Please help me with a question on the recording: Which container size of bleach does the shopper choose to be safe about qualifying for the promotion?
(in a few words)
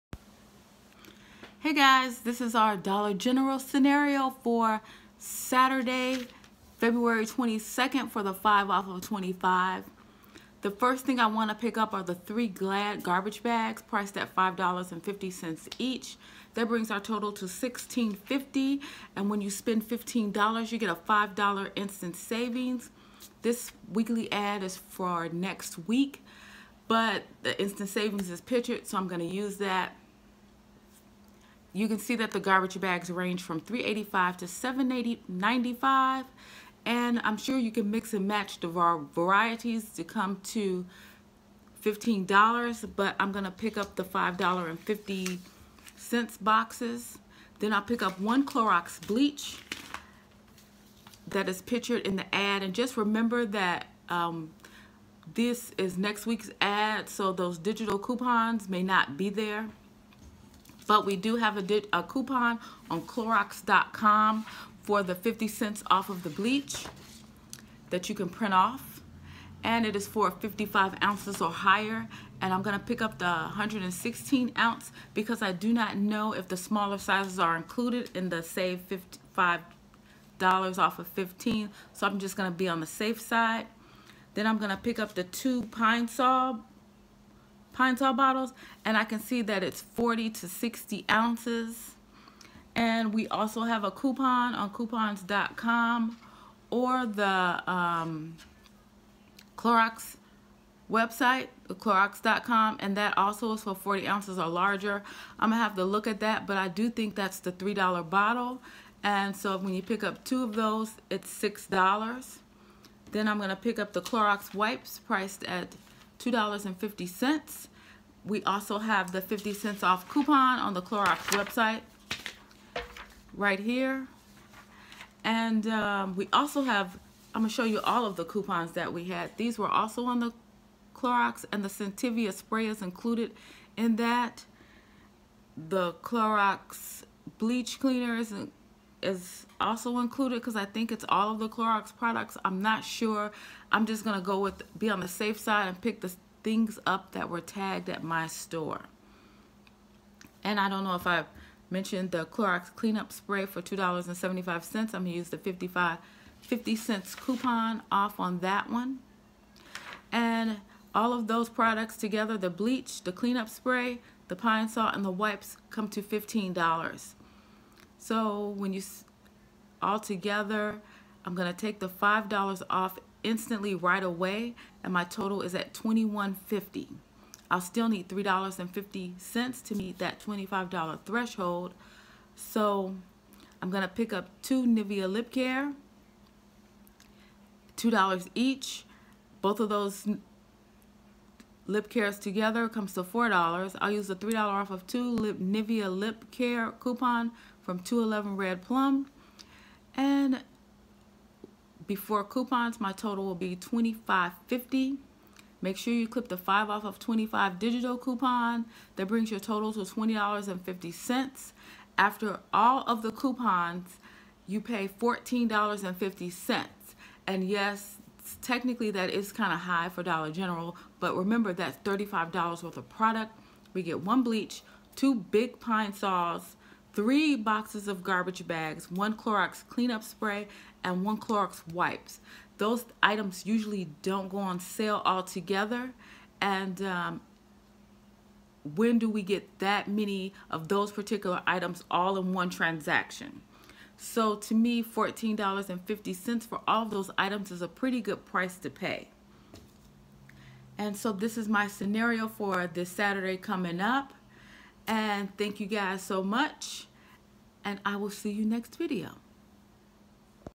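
116 ounce.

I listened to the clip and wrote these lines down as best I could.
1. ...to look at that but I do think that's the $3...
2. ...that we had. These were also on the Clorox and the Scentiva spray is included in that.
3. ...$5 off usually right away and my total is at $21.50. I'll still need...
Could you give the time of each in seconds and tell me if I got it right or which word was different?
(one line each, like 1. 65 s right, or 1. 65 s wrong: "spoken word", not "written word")
1. 105 s right
2. 128 s right
3. 171 s wrong: "instantly", not "usually".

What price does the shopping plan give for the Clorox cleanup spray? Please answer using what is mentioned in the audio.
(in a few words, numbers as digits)
$2.75.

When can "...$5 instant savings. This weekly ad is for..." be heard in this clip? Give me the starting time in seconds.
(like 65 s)
20 s.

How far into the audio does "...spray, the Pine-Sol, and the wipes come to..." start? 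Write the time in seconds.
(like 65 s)
163 s.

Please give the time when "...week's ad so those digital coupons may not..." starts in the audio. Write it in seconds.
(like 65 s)
56 s.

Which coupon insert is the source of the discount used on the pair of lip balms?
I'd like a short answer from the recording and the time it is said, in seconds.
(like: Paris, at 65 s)
211 Red Plum, at 197 s.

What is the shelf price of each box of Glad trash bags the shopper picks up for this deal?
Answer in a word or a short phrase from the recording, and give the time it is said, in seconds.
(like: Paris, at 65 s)
$5.50, at 14 s.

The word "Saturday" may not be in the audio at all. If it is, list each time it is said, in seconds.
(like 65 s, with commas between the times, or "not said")
5 s, 252 s.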